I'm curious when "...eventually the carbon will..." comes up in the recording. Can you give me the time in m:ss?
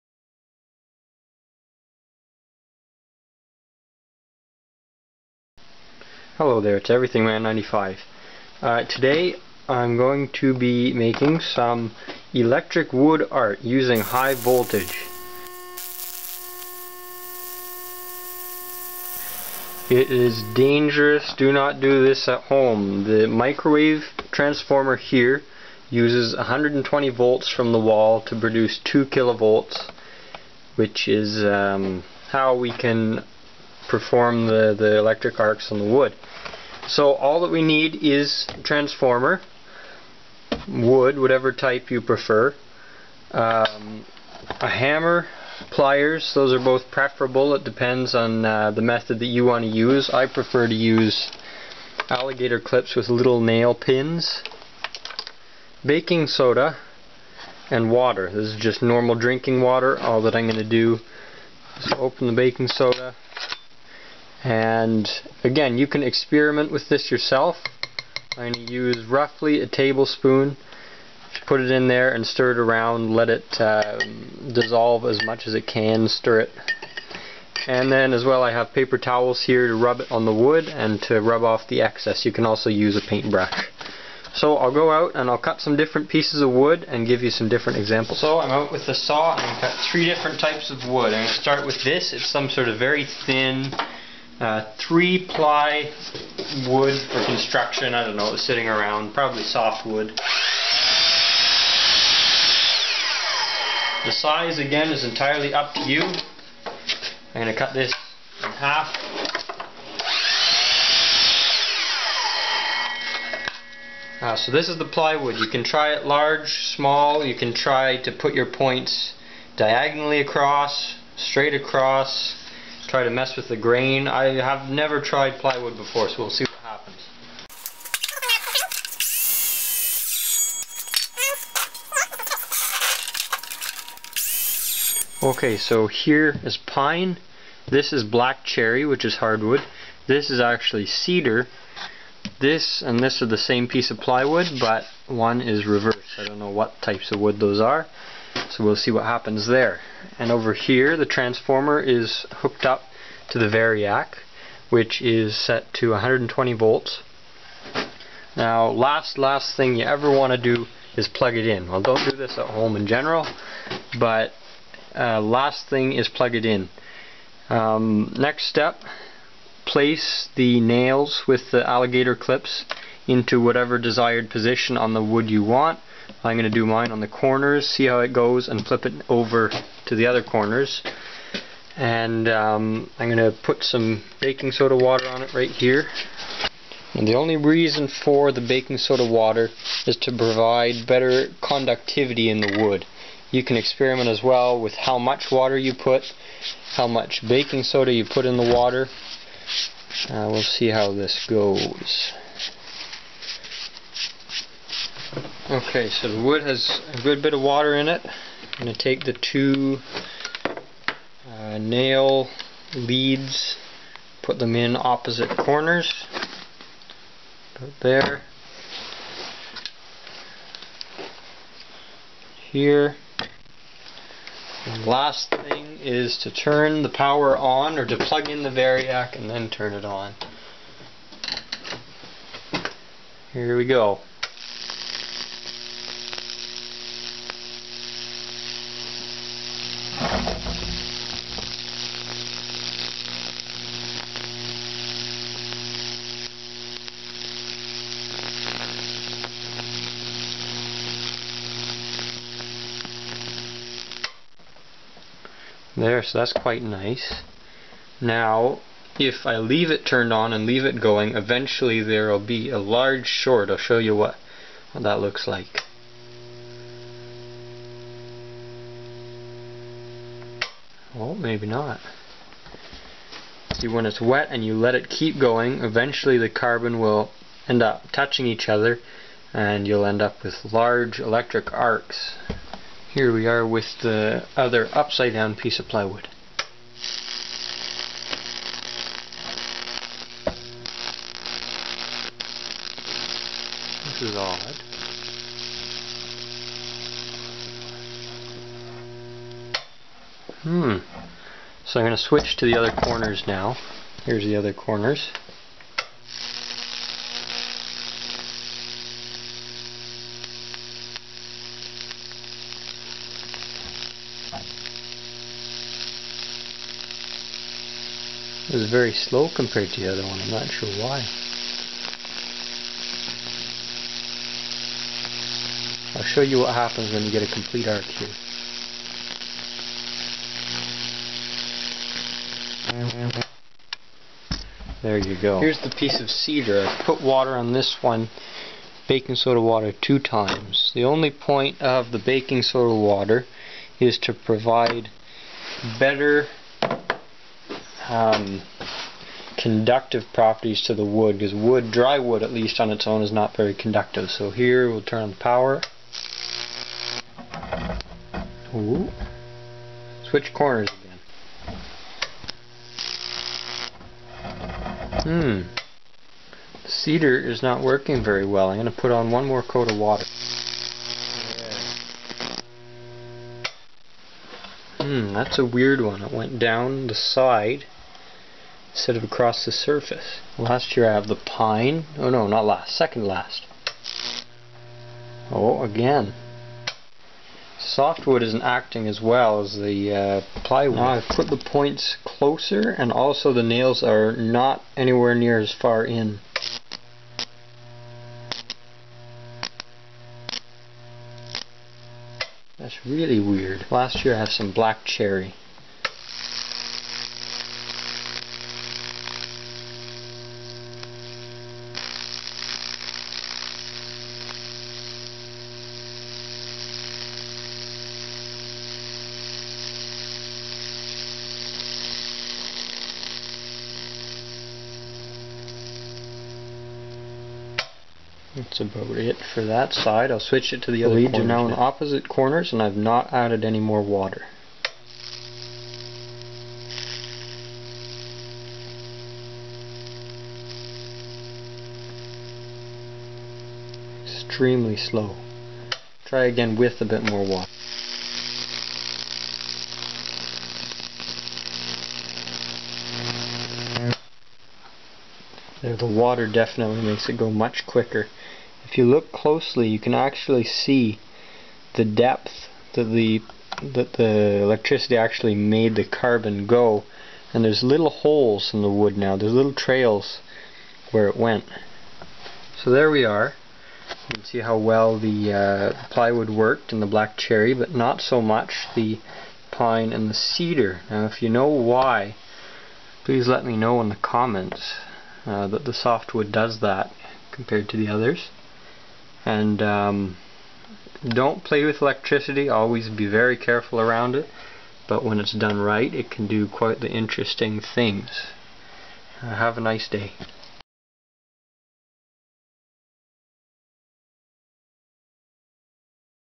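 4:35.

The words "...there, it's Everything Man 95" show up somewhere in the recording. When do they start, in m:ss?
0:06.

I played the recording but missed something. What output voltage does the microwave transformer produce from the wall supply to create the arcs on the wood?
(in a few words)
2 kilovolts.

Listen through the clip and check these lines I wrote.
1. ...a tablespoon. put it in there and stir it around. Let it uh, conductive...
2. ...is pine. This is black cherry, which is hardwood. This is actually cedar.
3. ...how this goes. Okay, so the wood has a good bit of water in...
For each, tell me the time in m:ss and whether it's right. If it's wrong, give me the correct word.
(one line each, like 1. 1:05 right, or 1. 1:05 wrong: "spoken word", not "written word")
1. 1:09 wrong: "dissolve", not "conductive"
2. 2:16 right
3. 3:20 right.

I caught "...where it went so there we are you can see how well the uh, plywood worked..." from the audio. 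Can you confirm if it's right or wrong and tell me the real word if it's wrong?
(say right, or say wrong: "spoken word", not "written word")
right.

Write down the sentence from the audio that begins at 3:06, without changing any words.
And the only reason for the baking soda water is to provide better conductivity in the wood.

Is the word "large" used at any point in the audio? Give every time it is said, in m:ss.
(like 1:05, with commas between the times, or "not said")
1:56, 4:22, 4:40.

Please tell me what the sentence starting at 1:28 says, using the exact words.
So I'm out with the saw and I'm cut three different types of wood.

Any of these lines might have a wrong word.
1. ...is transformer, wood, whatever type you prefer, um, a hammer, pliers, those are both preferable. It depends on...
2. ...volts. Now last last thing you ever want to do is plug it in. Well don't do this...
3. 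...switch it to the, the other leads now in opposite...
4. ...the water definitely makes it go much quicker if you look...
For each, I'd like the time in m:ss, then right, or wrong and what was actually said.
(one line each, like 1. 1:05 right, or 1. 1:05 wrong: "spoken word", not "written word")
1. 0:38 right
2. 2:36 right
3. 7:10 right
4. 7:35 right.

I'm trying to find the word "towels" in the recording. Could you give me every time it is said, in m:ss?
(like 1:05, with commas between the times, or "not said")
1:18.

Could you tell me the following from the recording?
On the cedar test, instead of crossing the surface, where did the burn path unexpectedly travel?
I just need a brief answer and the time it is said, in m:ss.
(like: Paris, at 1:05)
down the side, at 6:16.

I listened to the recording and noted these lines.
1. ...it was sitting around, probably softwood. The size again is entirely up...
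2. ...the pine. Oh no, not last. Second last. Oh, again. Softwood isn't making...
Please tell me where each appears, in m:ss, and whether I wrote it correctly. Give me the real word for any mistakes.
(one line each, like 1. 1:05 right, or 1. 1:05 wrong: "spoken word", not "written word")
1. 1:38 right
2. 6:21 wrong: "acting", not "making".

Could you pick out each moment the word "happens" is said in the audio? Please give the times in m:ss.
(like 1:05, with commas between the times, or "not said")
2:06, 2:29, 5:26.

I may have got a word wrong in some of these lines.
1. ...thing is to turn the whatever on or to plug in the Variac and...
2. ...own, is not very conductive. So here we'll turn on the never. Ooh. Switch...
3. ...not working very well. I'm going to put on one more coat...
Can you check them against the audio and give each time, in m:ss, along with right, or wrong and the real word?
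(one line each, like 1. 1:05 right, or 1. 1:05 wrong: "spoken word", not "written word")
1. 3:45 wrong: "power", not "whatever"
2. 5:52 wrong: "power", not "never"
3. 6:07 right.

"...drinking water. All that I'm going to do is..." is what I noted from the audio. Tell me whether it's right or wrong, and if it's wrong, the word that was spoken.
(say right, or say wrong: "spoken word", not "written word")
right.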